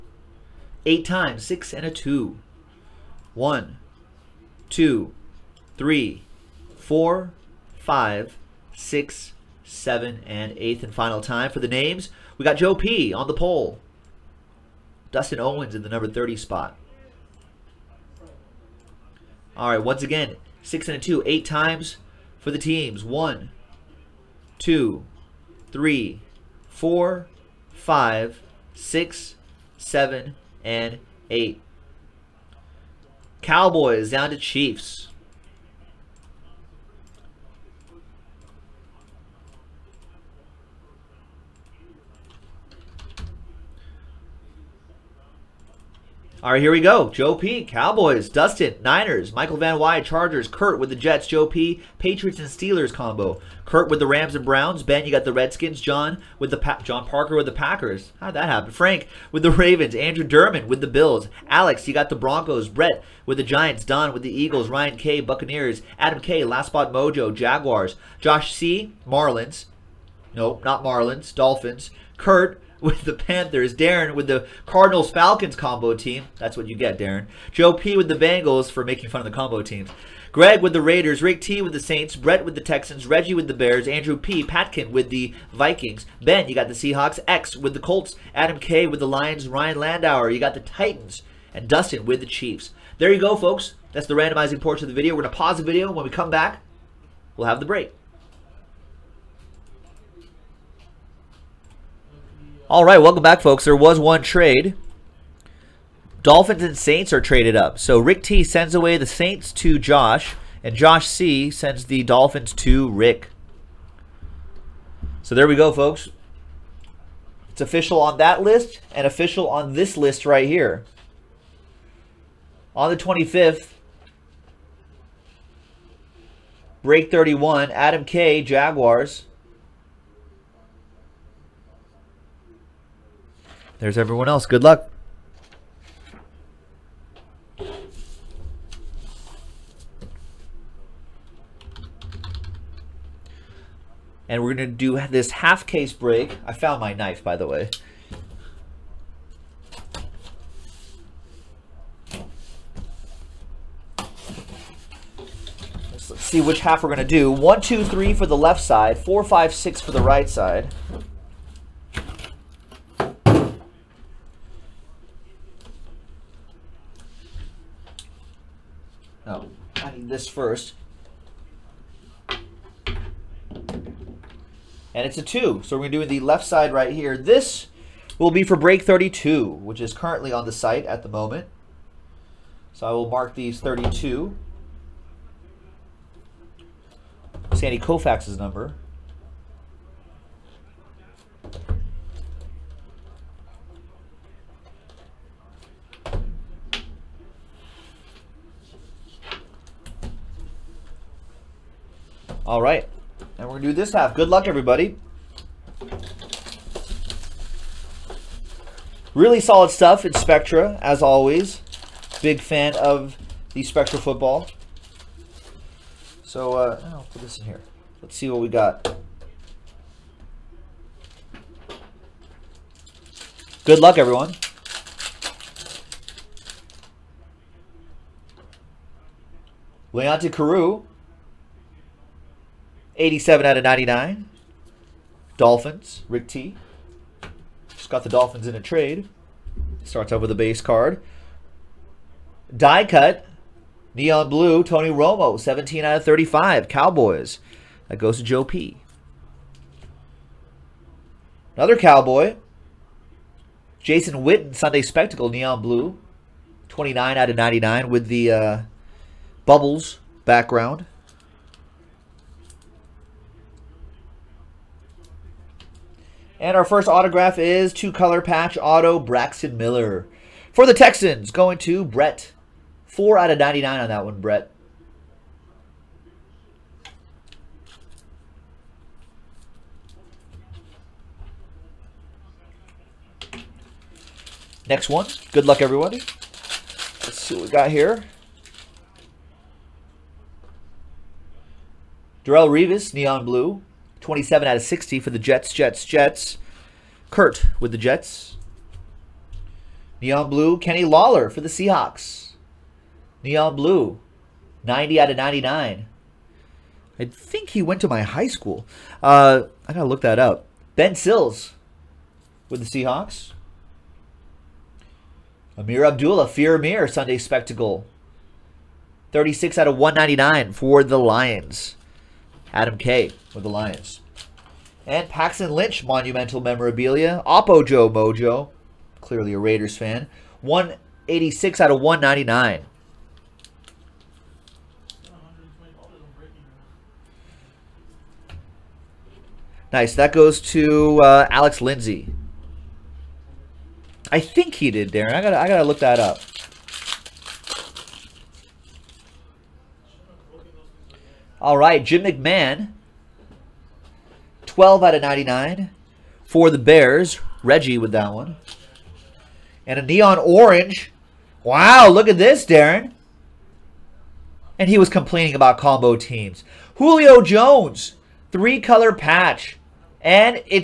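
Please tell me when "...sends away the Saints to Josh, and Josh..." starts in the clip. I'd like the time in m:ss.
1:48.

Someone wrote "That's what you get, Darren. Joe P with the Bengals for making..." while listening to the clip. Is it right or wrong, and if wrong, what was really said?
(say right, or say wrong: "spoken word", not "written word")
right.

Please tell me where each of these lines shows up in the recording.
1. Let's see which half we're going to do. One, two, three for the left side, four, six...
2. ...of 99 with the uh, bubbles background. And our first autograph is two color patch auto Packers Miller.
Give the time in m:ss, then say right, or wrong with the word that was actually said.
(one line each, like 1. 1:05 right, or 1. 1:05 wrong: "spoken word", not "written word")
1. 2:35 wrong: "five", not "six"
2. 4:17 wrong: "Braxton", not "Packers".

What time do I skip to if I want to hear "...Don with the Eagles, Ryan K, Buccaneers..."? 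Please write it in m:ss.
1:03.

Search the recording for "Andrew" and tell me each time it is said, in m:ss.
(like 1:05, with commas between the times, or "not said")
0:59, 1:23.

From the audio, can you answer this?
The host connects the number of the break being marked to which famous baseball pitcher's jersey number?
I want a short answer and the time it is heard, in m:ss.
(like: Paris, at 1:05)
Sandy Koufax, at 3:07.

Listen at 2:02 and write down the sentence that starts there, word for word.
On the 25th, break 31, Adam K, Jaguars.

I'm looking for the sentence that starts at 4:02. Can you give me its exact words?
Die cut, neon blue, Tony Romo, 17 out of 35.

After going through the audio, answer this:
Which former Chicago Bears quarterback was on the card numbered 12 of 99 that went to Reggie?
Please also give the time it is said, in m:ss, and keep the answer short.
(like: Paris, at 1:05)
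Jim McMahon, at 5:51.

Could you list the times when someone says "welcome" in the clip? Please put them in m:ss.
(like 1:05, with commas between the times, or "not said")
1:42.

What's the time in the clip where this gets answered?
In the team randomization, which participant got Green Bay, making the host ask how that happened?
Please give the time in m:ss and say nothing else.
0:56.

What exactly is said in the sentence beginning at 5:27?
Oppo Joe Mojo, clearly a Raiders fan.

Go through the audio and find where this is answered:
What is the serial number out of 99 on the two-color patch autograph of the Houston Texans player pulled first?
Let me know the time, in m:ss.
4:32.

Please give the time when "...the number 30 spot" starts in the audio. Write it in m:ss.
0:15.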